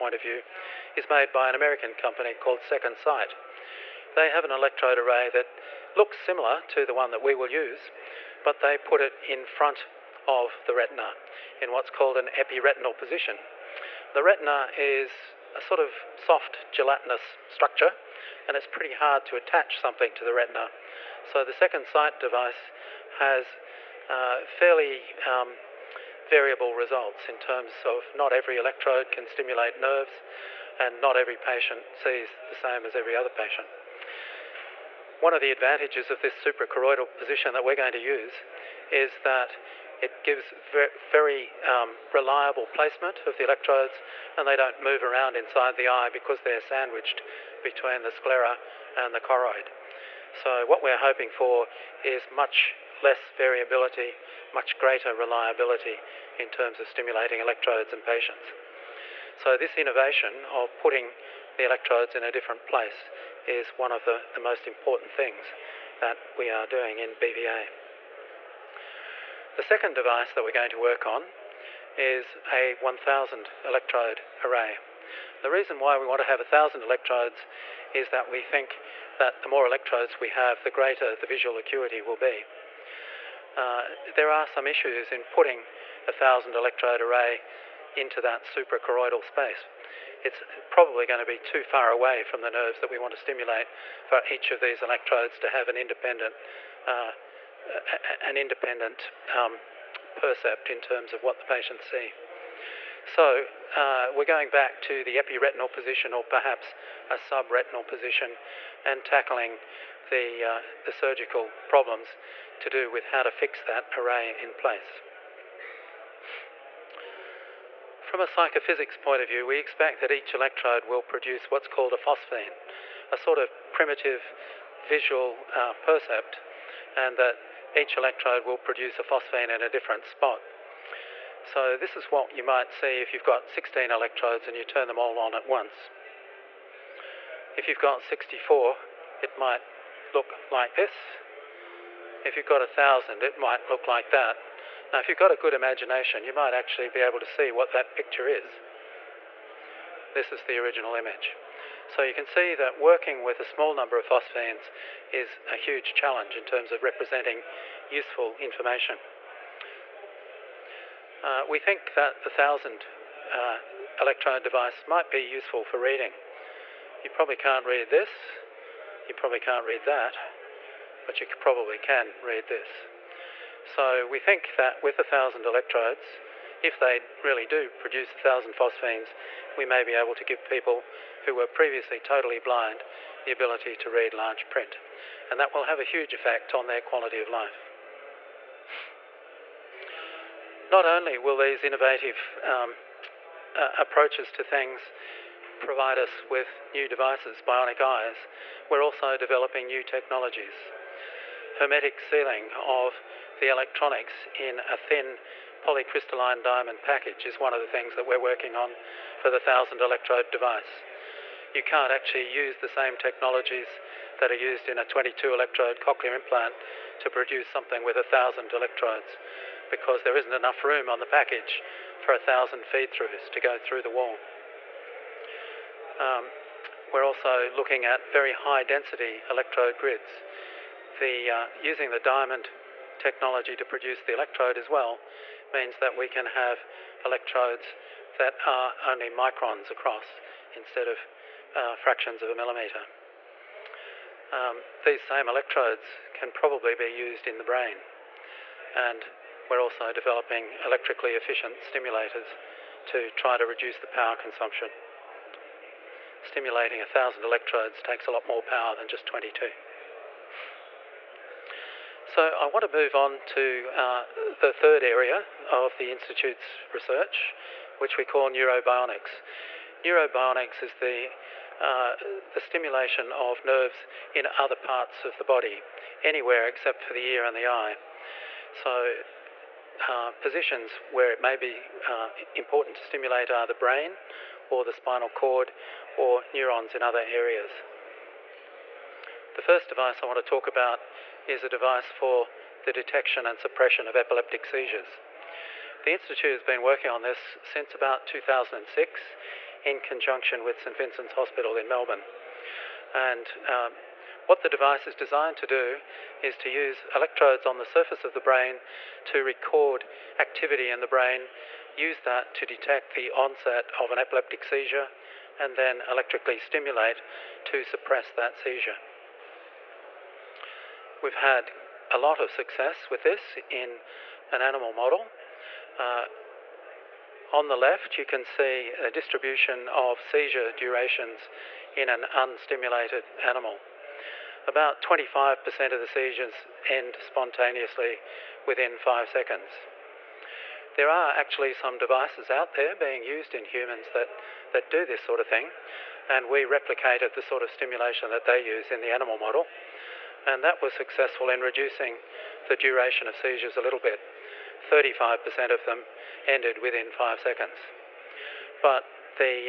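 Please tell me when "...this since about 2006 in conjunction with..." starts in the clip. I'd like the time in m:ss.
4:57.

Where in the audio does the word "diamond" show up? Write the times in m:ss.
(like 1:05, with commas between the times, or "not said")
3:26, 3:51.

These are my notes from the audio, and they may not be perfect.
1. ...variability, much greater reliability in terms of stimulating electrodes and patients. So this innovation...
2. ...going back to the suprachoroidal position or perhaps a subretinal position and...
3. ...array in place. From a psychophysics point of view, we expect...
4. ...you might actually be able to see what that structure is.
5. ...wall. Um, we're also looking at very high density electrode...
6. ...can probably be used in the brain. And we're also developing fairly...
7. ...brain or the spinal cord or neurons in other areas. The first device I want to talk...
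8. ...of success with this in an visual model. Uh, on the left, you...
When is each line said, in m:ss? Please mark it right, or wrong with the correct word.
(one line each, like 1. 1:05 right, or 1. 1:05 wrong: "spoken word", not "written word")
1. 0:53 right
2. 1:44 wrong: "epiretinal", not "suprachoroidal"
3. 1:53 right
4. 2:26 wrong: "picture", not "structure"
5. 3:43 right
6. 4:06 wrong: "electrically", not "fairly"
7. 4:43 right
8. 5:22 wrong: "animal", not "visual".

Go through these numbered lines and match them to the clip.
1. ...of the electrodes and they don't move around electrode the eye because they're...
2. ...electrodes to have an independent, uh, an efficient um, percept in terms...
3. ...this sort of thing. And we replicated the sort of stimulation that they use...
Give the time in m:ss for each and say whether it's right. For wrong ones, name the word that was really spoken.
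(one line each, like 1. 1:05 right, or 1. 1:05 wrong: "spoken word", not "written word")
1. 0:43 wrong: "inside", not "electrode"
2. 1:34 wrong: "independent", not "efficient"
3. 5:44 right.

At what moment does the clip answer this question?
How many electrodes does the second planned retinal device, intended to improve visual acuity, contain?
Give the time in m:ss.
1:12.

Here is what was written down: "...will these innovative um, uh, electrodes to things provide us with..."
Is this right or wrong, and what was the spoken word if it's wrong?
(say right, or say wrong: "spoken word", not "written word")
wrong: "approaches", not "electrodes".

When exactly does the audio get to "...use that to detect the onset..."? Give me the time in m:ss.
5:11.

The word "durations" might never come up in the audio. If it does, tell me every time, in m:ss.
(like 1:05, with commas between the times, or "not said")
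5:30, 5:52.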